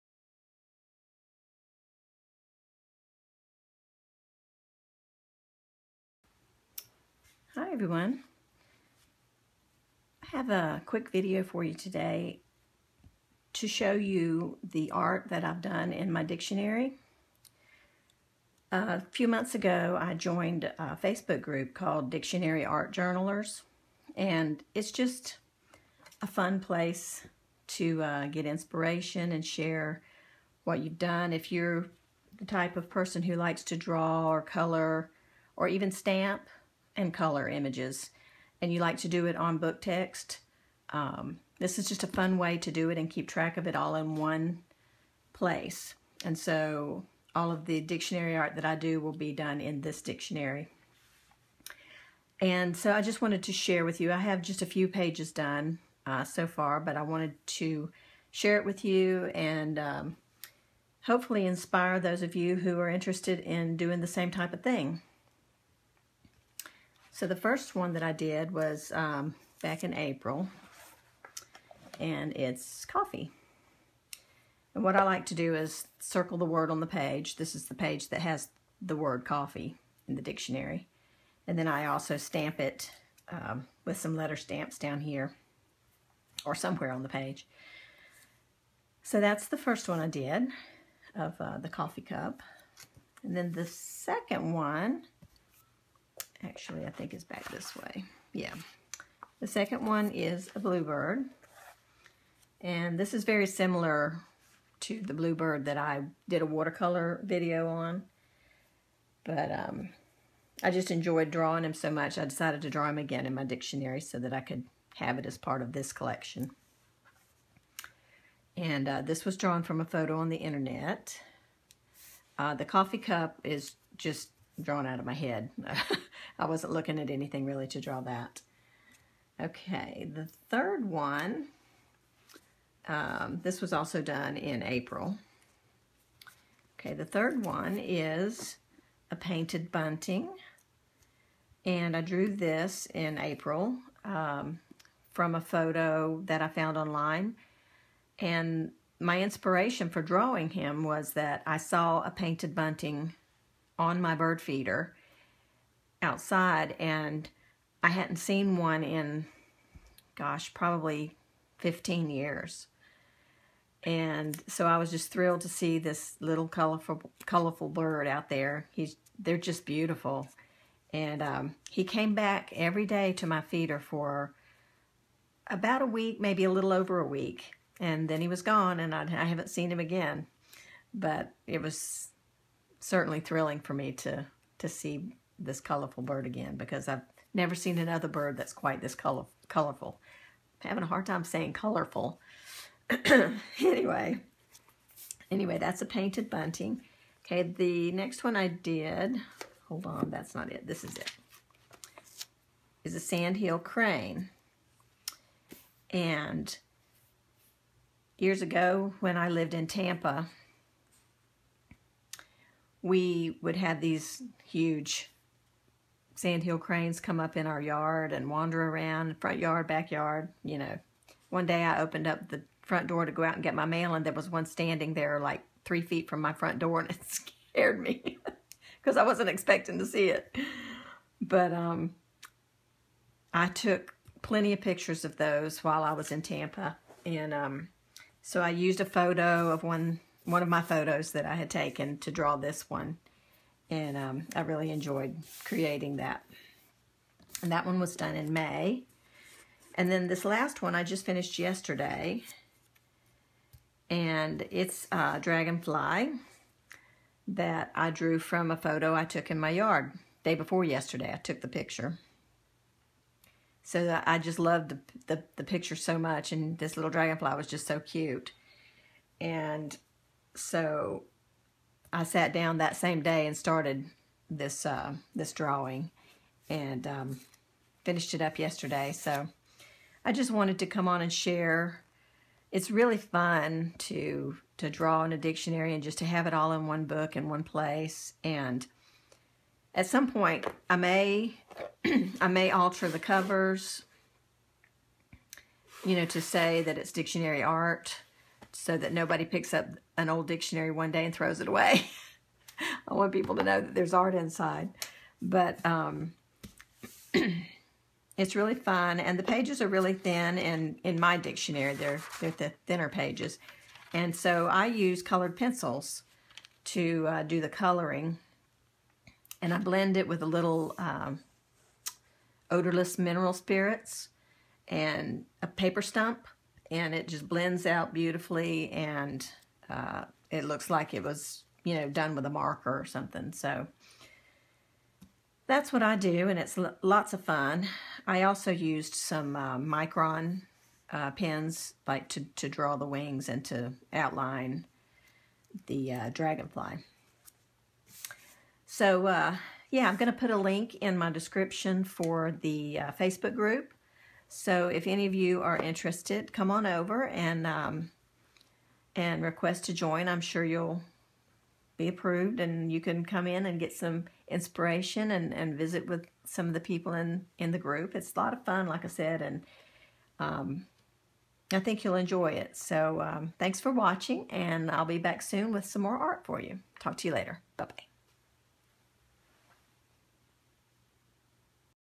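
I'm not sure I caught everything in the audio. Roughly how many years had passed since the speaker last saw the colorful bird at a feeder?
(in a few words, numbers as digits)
15.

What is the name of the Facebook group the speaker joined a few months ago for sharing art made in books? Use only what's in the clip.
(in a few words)
Dictionary Art Journalers.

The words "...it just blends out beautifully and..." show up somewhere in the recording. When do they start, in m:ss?
5:26.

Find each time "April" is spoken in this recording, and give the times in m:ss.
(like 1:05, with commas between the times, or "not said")
1:09, 2:14, 2:23.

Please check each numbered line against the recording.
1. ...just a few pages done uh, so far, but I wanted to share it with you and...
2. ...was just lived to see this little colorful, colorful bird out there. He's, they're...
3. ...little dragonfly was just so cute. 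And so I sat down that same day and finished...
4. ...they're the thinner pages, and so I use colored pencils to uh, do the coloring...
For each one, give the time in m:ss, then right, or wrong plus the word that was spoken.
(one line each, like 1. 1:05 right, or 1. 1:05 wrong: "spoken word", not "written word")
1. 0:54 right
2. 2:44 wrong: "thrilled", not "lived"
3. 4:26 wrong: "started", not "finished"
4. 5:12 right.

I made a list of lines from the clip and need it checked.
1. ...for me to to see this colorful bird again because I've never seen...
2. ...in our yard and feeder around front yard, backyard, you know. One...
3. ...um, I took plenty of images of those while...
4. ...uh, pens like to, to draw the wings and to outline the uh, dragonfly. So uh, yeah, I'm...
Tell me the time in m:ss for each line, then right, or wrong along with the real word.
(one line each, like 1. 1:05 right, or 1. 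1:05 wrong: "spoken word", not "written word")
1. 3:03 right
2. 3:37 wrong: "wander", not "feeder"
3. 3:51 wrong: "pictures", not "images"
4. 5:40 right.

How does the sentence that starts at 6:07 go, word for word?
It's a lot of fun, like I said, and um, I think you'll enjoy it.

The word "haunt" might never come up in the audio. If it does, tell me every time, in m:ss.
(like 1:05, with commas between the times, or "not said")
not said.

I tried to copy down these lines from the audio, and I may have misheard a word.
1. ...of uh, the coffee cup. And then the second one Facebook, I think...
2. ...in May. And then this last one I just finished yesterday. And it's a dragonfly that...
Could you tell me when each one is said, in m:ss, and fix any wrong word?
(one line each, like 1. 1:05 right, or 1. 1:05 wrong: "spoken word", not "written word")
1. 1:31 wrong: "Actually", not "Facebook"
2. 4:08 right.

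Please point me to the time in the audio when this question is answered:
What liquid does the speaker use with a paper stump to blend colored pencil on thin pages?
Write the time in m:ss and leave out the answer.
5:22.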